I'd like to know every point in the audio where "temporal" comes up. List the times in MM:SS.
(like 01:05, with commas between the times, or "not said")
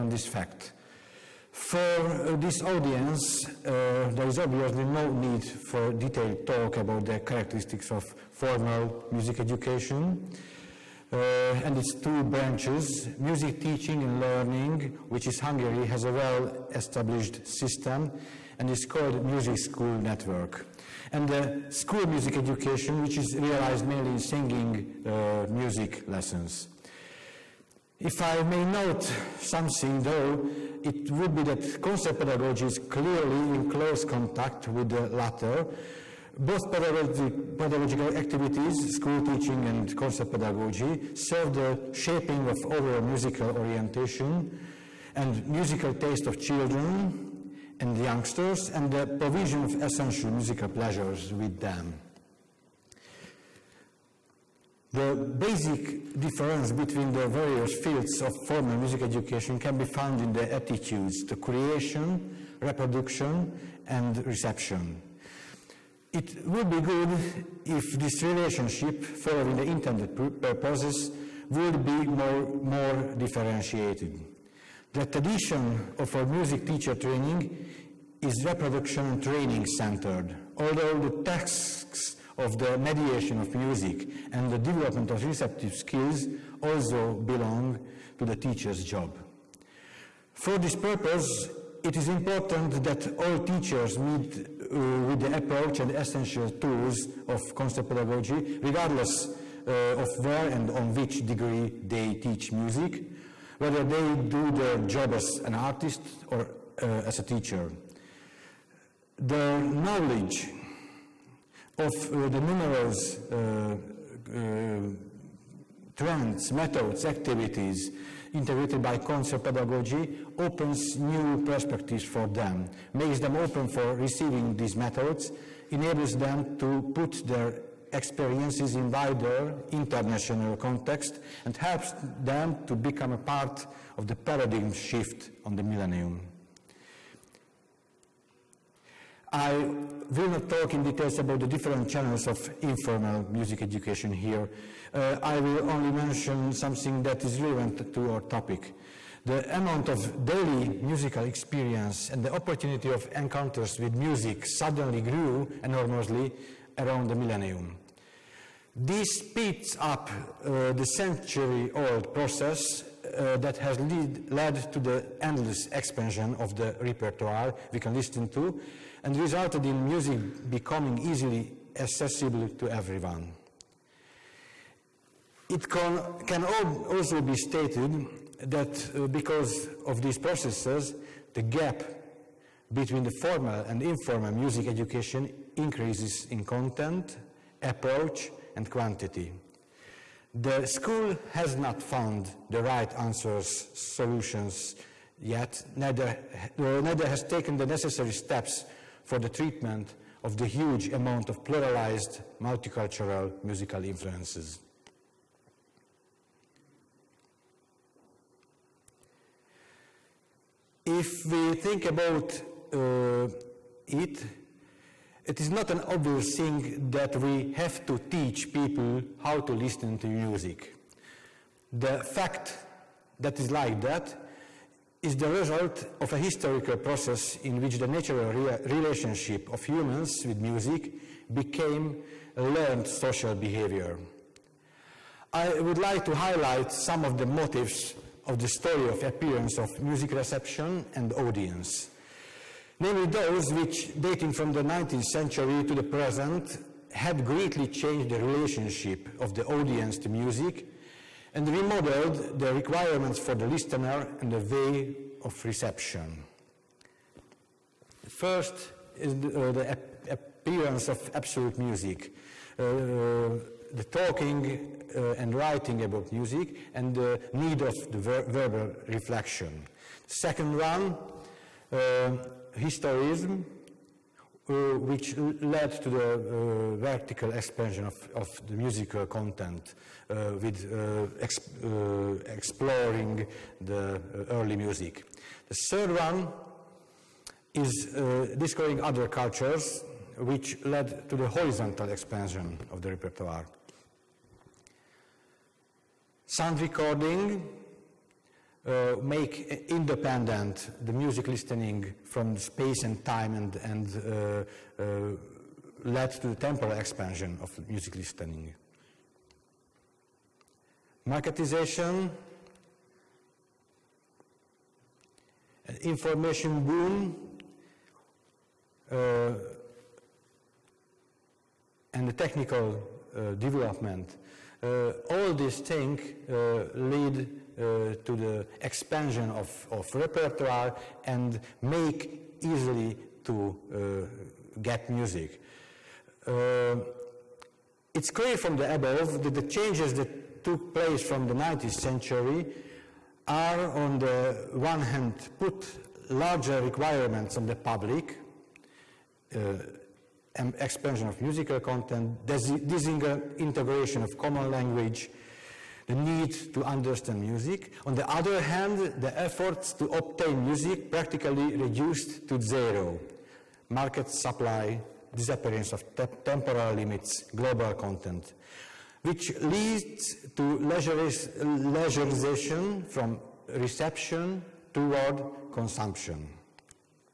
05:06, 06:06.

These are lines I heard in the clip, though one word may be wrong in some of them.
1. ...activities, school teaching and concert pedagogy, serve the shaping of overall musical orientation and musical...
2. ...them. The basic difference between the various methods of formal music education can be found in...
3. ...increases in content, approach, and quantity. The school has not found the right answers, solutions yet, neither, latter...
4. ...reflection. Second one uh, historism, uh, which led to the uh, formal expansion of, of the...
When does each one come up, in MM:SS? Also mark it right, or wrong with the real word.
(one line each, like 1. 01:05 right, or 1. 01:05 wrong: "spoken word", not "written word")
1. 00:38 right
2. 00:51 wrong: "fields", not "methods"
3. 03:05 wrong: "neither", not "latter"
4. 04:28 wrong: "vertical", not "formal".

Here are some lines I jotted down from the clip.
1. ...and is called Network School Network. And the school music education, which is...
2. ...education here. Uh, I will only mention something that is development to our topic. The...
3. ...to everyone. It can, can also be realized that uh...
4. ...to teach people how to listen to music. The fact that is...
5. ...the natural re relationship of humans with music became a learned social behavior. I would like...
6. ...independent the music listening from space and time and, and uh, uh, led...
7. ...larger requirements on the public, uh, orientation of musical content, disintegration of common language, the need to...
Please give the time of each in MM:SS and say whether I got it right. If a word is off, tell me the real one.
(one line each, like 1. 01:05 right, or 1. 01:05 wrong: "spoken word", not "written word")
1. 00:18 wrong: "Music", not "Network"
2. 02:23 wrong: "relevant", not "development"
3. 02:52 wrong: "stated", not "realized"
4. 03:37 right
5. 03:47 right
6. 04:59 right
7. 05:46 wrong: "expansion", not "orientation".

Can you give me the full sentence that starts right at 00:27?
If I may note something though, it would be that concert pedagogy is clearly in close contact with the latter.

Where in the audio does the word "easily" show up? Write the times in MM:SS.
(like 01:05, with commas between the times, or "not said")
02:51, 05:32.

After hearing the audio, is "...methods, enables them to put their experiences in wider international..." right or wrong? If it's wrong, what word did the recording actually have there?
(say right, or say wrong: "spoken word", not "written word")
right.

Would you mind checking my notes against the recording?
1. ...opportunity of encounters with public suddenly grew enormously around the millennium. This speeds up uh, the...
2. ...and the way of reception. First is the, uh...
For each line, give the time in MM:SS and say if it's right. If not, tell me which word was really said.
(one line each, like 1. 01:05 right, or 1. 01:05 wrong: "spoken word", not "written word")
1. 02:32 wrong: "music", not "public"
2. 04:14 right.